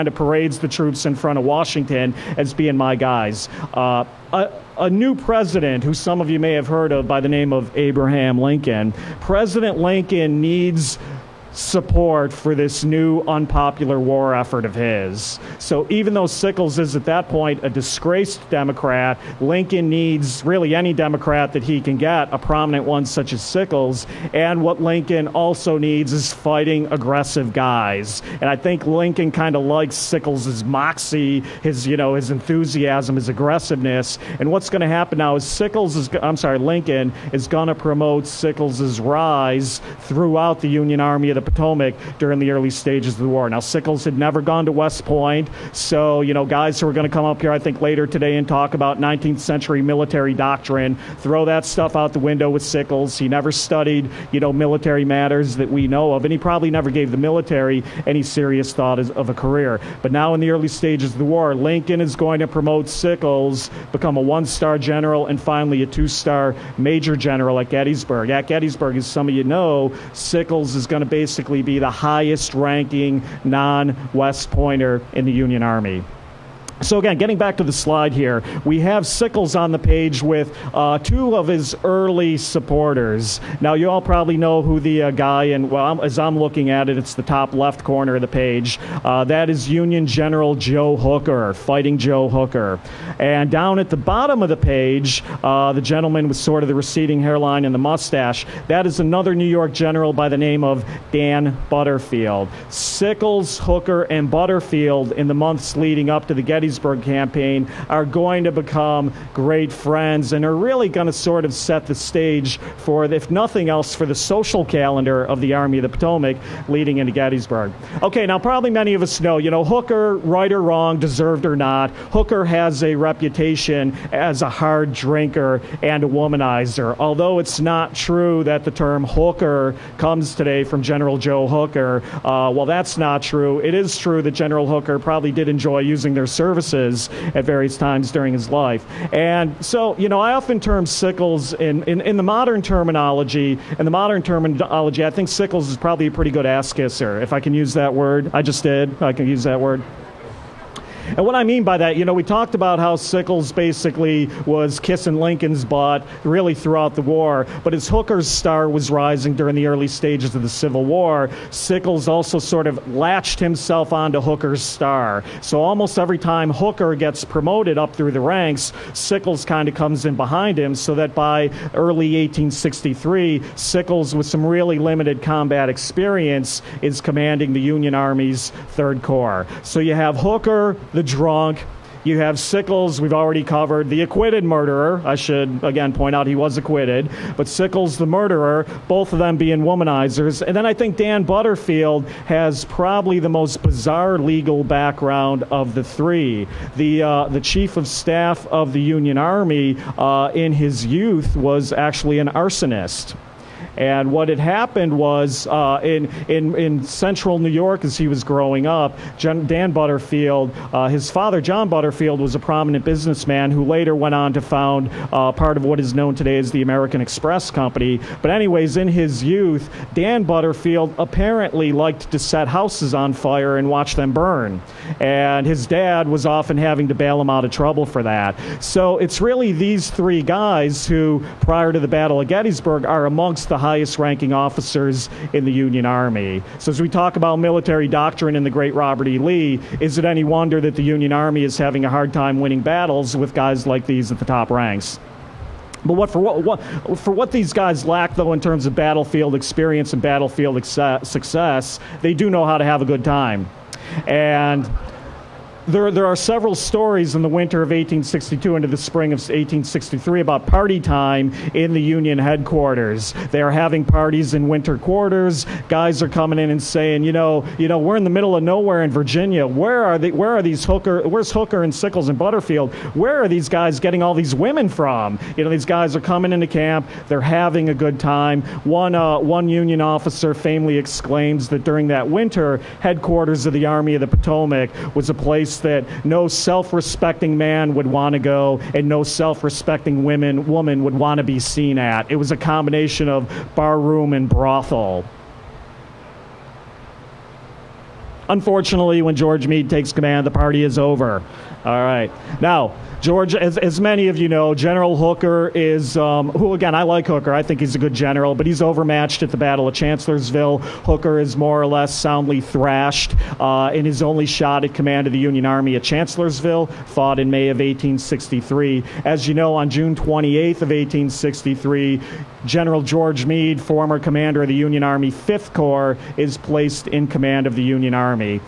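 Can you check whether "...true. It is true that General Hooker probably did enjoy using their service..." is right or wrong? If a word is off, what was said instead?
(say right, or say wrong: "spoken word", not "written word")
right.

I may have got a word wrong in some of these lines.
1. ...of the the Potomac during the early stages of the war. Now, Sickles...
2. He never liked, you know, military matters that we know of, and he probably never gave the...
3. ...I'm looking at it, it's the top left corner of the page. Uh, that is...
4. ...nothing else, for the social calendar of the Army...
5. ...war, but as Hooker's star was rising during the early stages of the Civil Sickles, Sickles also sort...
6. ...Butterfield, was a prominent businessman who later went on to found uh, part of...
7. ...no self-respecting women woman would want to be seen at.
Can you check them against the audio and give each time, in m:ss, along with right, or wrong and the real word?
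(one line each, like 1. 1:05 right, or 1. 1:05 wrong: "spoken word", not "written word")
1. 0:41 right
2. 0:53 wrong: "studied", not "liked"
3. 1:26 right
4. 1:53 right
5. 2:37 wrong: "War", not "Sickles"
6. 3:31 right
7. 4:48 right.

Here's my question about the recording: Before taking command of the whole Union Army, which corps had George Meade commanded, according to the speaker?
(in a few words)
5th Corps.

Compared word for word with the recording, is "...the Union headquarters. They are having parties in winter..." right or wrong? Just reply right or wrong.
right.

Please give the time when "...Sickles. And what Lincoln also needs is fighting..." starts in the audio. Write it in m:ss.
0:23.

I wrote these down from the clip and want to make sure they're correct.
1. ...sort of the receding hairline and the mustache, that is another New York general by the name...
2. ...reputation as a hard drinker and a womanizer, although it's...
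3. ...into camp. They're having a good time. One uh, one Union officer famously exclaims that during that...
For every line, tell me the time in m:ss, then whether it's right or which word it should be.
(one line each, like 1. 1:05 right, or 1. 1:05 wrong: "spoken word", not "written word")
1. 1:36 right
2. 2:02 right
3. 4:36 right.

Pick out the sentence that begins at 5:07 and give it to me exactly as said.
I think he's a good general, but he's overmatched at the Battle of Chancellorsville.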